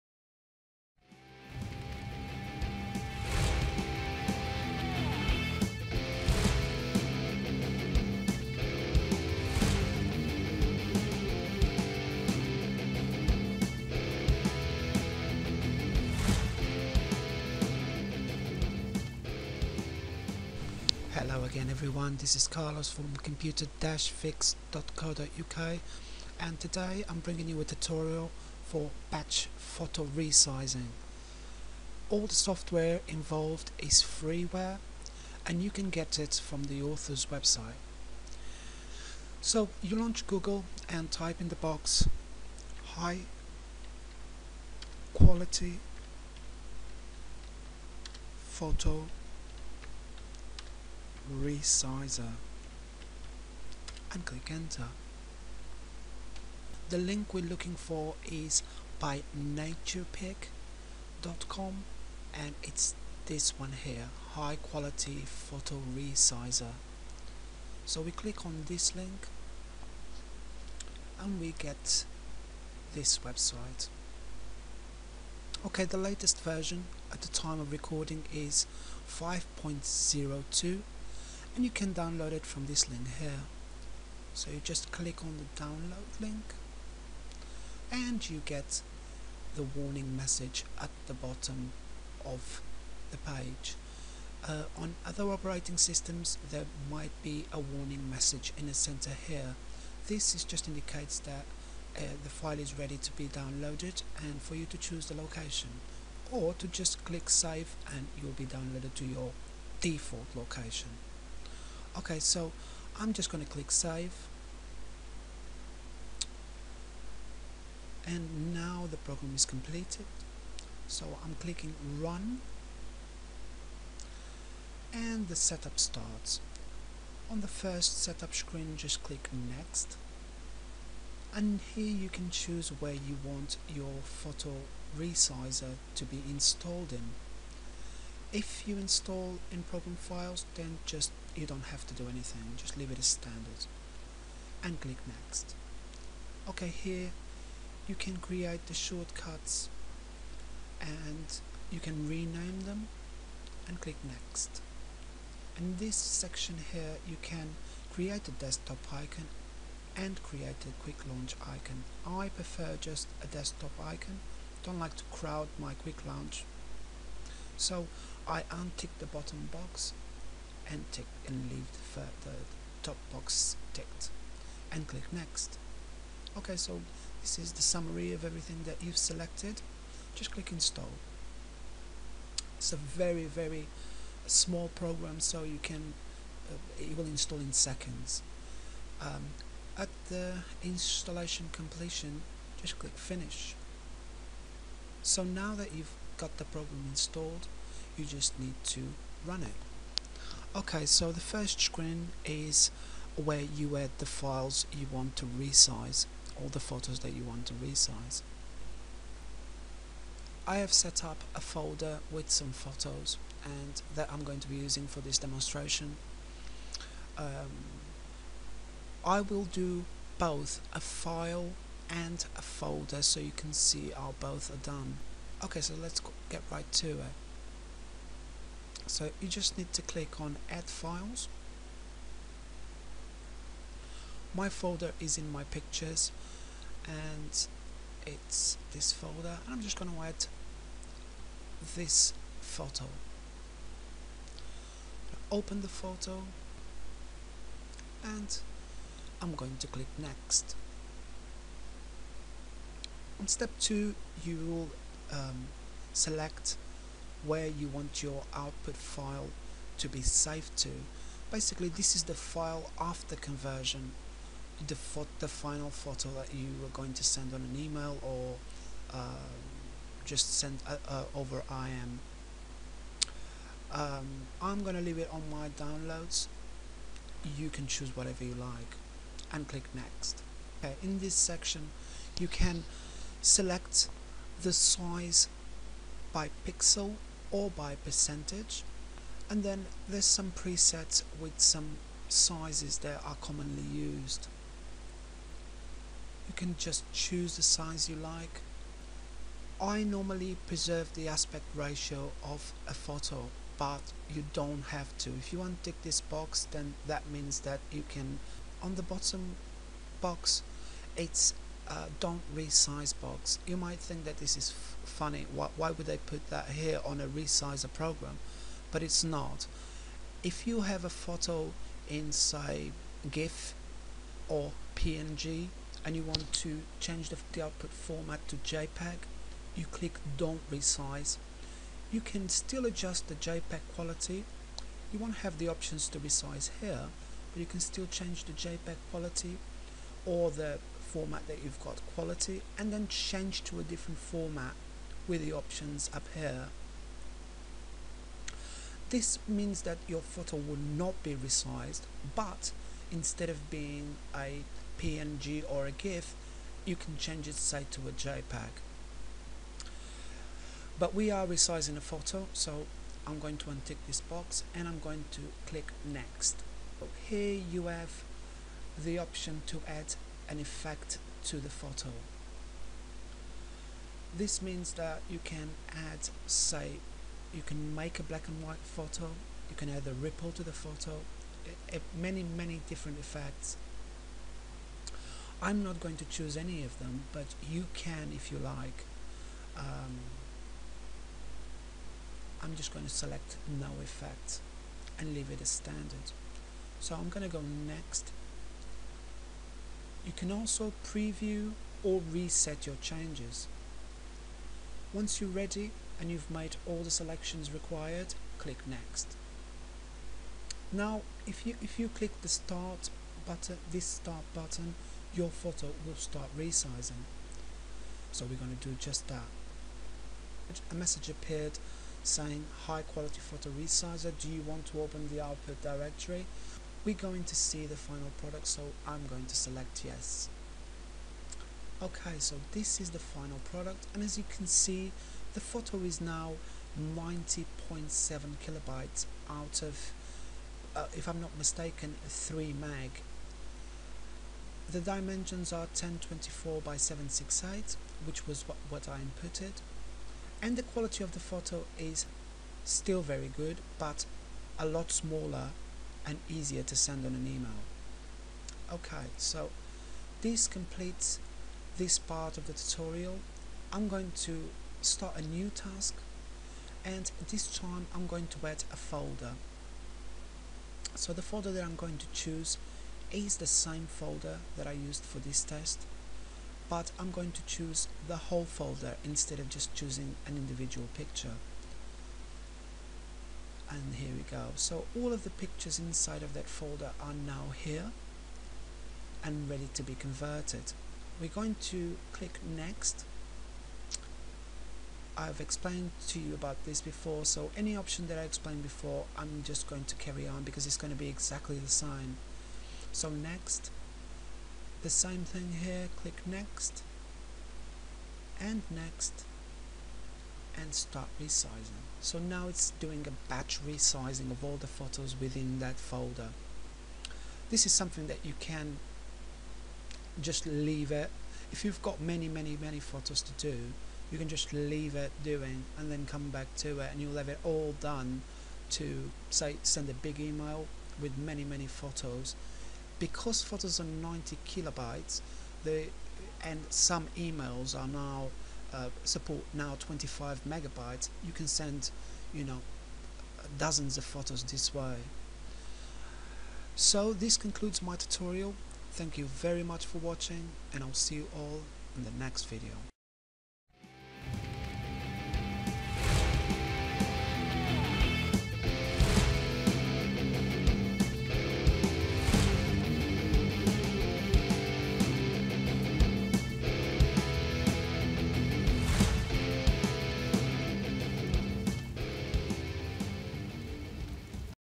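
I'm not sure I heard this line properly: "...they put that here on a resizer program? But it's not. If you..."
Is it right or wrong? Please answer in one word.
right.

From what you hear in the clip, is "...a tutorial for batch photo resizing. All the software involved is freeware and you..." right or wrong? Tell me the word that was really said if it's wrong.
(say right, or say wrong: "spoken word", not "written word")
right.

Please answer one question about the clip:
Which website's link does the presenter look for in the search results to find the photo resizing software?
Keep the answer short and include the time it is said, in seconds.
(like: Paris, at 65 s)
naturpic.com, at 59 s.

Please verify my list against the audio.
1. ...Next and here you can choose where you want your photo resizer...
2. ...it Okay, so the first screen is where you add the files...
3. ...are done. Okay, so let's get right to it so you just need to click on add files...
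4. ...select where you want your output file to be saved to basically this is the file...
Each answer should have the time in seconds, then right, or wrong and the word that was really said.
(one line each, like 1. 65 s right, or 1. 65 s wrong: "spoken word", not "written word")
1. 129 s right
2. 199 s right
3. 224 s right
4. 255 s right.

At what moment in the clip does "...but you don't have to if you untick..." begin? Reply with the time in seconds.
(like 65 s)
303 s.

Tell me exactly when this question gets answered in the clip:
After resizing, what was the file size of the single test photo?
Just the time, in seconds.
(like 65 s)
436 s.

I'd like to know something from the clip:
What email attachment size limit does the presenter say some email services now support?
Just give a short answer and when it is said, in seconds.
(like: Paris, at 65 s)
25 megabytes, at 539 s.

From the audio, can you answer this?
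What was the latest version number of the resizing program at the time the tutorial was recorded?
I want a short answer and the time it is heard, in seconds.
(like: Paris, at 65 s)
5.02, at 79 s.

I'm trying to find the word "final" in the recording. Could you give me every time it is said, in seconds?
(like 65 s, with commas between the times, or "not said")
265 s, 427 s, 432 s.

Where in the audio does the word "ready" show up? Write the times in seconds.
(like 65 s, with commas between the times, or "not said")
102 s, 405 s, 489 s.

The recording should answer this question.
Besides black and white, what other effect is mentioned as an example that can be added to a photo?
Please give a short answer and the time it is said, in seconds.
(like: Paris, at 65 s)
Ripple, at 379 s.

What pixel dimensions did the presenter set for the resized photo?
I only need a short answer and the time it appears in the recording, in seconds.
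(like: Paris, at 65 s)
1024 by 768, at 445 s.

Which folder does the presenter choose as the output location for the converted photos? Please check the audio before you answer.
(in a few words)
Downloads.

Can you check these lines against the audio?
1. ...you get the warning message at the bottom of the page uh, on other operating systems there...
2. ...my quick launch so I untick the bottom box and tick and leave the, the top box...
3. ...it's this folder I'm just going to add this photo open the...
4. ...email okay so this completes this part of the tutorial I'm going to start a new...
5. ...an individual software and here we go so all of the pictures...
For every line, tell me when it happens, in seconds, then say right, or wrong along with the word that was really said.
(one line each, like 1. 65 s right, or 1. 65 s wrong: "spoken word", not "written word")
1. 88 s right
2. 165 s right
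3. 238 s right
4. 457 s right
5. 480 s wrong: "picture", not "software".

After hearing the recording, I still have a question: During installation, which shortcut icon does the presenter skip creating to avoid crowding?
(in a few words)
Quick launch icon.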